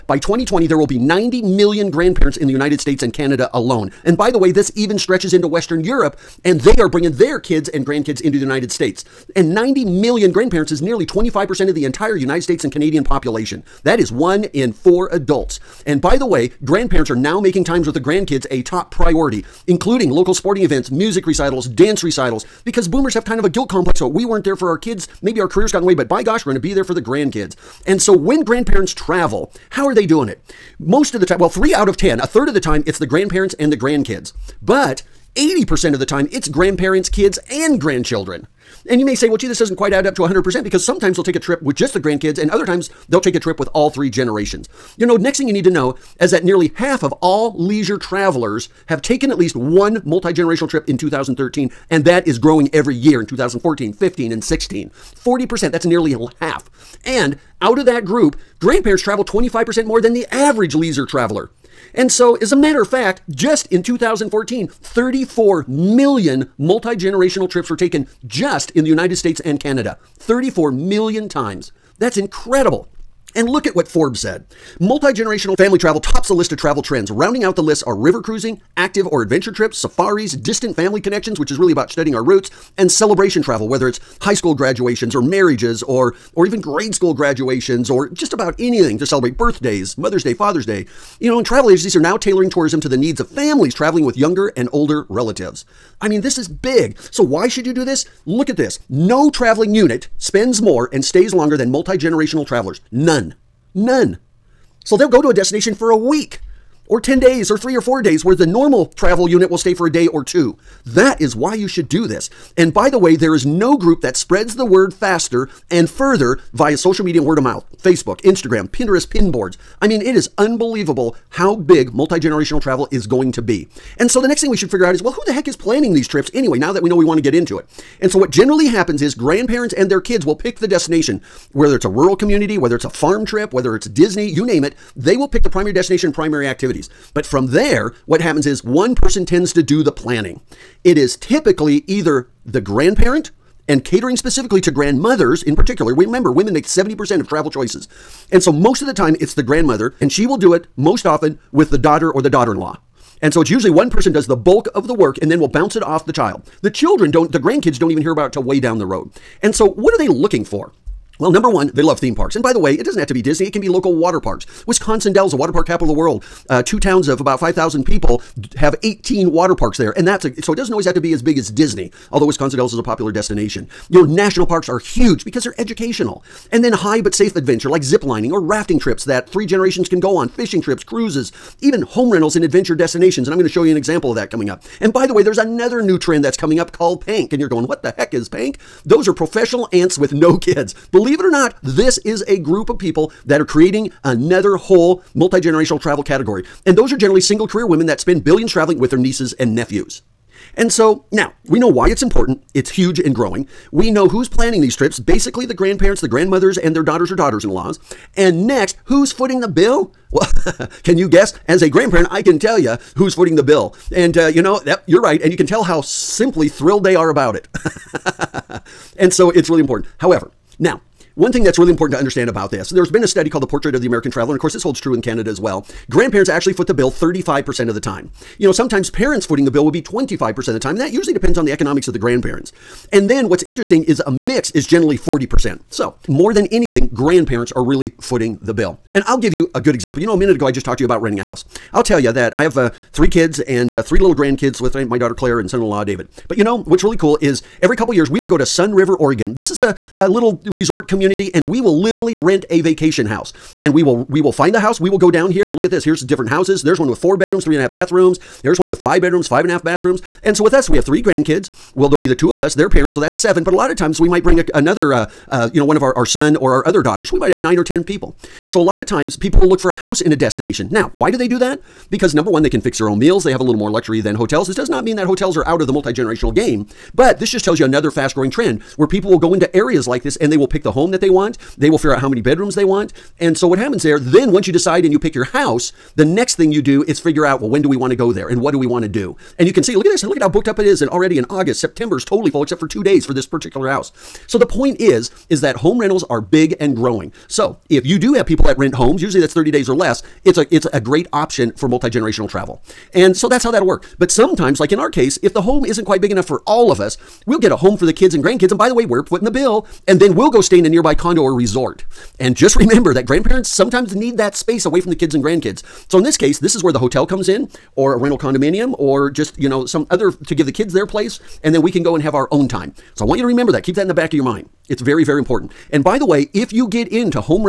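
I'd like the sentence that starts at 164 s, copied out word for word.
Wisconsin Dells, the water park capital of the world.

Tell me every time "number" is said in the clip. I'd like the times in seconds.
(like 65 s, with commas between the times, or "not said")
161 s, 272 s.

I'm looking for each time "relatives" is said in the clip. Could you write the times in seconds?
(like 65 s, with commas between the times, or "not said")
95 s.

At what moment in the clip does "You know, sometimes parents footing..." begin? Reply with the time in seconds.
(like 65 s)
228 s.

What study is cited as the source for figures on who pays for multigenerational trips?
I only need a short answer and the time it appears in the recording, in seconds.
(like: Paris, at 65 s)
The Portrait of the American Traveler, at 223 s.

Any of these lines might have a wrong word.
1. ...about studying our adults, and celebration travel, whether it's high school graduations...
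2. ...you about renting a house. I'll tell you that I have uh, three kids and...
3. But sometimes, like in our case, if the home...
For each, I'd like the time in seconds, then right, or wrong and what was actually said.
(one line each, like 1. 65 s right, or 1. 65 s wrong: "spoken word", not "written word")
1. 81 s wrong: "roots", not "adults"
2. 240 s right
3. 303 s right.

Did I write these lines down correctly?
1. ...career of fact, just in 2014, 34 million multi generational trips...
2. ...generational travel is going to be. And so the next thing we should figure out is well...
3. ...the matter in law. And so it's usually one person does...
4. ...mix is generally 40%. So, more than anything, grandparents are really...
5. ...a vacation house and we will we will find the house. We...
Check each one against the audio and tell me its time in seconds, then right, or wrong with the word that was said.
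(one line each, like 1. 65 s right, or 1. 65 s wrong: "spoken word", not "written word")
1. 62 s wrong: "matter", not "career"
2. 122 s right
3. 152 s wrong: "daughter", not "matter"
4. 234 s right
5. 252 s right.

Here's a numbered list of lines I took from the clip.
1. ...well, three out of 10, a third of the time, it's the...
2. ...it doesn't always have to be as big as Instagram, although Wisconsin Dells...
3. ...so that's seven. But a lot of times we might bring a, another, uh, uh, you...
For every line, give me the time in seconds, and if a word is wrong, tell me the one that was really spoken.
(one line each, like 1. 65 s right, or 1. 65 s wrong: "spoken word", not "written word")
1. 31 s right
2. 170 s wrong: "Disney", not "Instagram"
3. 262 s right.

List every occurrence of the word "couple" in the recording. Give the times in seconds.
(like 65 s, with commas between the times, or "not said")
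247 s.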